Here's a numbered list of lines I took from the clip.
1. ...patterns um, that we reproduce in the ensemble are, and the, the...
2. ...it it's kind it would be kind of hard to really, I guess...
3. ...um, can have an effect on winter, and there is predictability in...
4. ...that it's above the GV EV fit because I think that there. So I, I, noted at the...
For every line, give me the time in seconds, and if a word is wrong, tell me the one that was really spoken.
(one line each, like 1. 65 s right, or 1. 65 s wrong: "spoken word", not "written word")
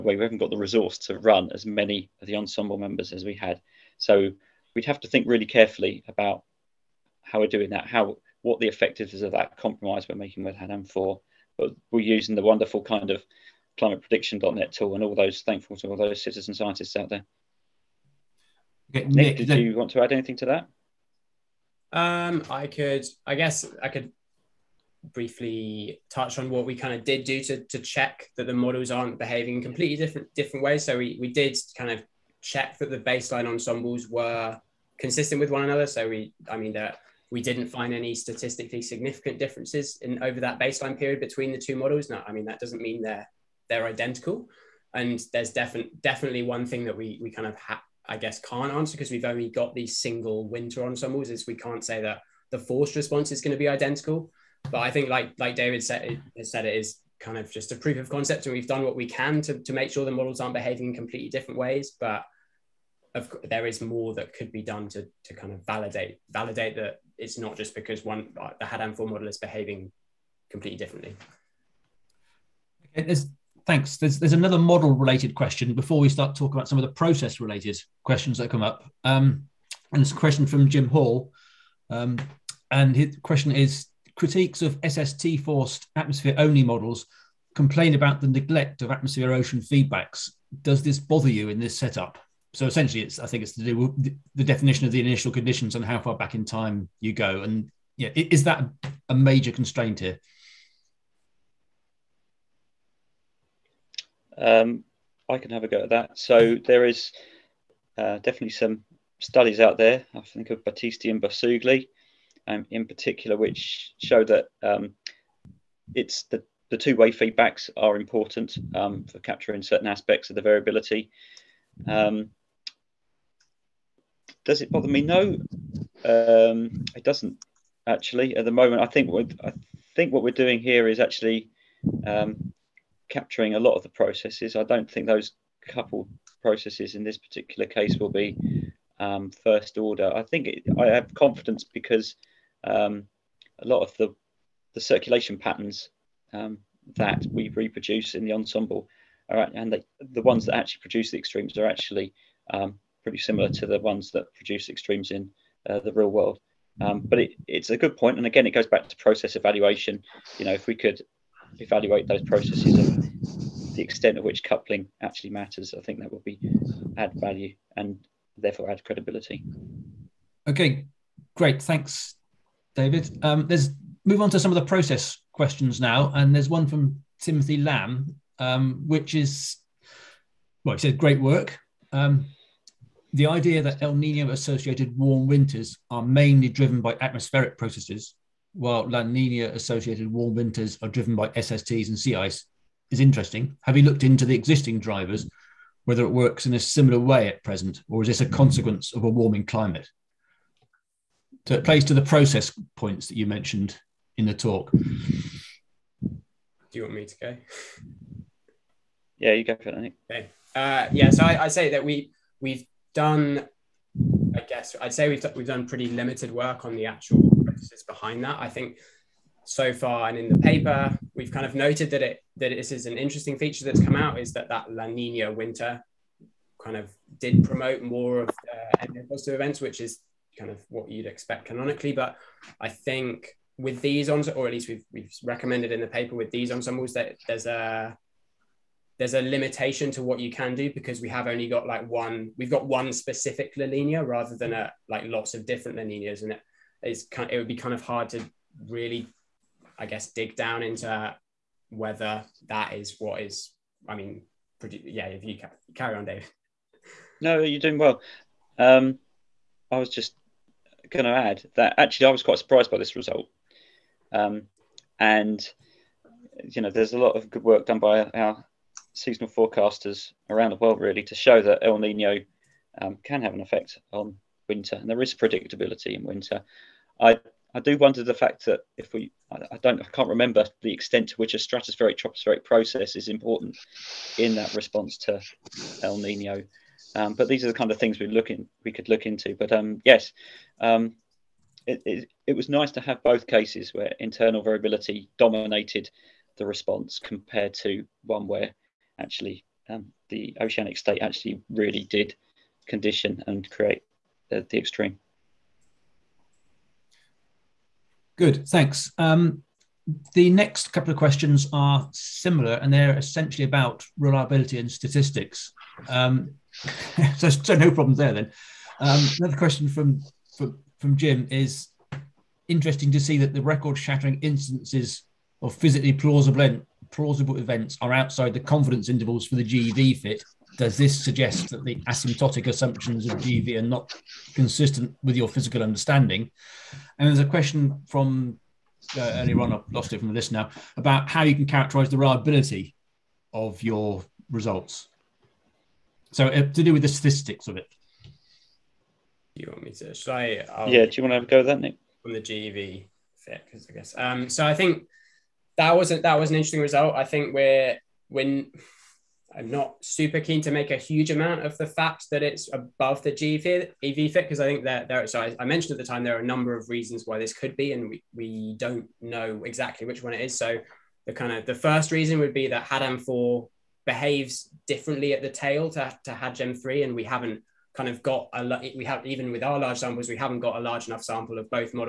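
1. 145 s right
2. 246 s right
3. 272 s right
4. 362 s wrong: "mentioned", not "noted".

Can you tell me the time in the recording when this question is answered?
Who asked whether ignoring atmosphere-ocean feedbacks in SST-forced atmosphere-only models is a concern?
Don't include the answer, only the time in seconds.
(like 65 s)
80 s.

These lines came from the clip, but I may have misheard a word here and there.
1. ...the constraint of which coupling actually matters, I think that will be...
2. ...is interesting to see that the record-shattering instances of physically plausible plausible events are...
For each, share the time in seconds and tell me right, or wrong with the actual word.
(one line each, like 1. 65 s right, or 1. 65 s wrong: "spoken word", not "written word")
1. 163 s wrong: "extent", not "constraint"
2. 321 s right.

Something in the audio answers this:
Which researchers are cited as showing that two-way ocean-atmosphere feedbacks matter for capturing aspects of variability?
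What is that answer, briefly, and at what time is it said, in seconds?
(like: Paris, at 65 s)
Battisti and Barsugli, at 110 s.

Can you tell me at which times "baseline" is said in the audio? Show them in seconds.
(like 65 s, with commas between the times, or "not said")
32 s, 40 s.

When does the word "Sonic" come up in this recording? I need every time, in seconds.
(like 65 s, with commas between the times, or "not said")
not said.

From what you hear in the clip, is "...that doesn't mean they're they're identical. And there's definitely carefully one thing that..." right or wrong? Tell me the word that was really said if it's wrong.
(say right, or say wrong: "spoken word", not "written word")
wrong: "definitely", not "carefully".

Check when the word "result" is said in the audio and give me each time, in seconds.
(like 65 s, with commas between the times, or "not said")
262 s, 344 s, 356 s.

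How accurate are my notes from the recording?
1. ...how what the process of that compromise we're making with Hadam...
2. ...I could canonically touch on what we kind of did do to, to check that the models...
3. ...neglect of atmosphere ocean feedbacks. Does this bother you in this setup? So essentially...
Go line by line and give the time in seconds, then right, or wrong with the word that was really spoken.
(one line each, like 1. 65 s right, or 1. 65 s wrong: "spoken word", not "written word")
1. 7 s wrong: "effectiveness", not "process"
2. 23 s wrong: "briefly", not "canonically"
3. 88 s right.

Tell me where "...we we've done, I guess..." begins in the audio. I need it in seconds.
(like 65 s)
211 s.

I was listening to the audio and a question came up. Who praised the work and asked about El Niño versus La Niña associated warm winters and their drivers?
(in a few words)
Timothy Lamb.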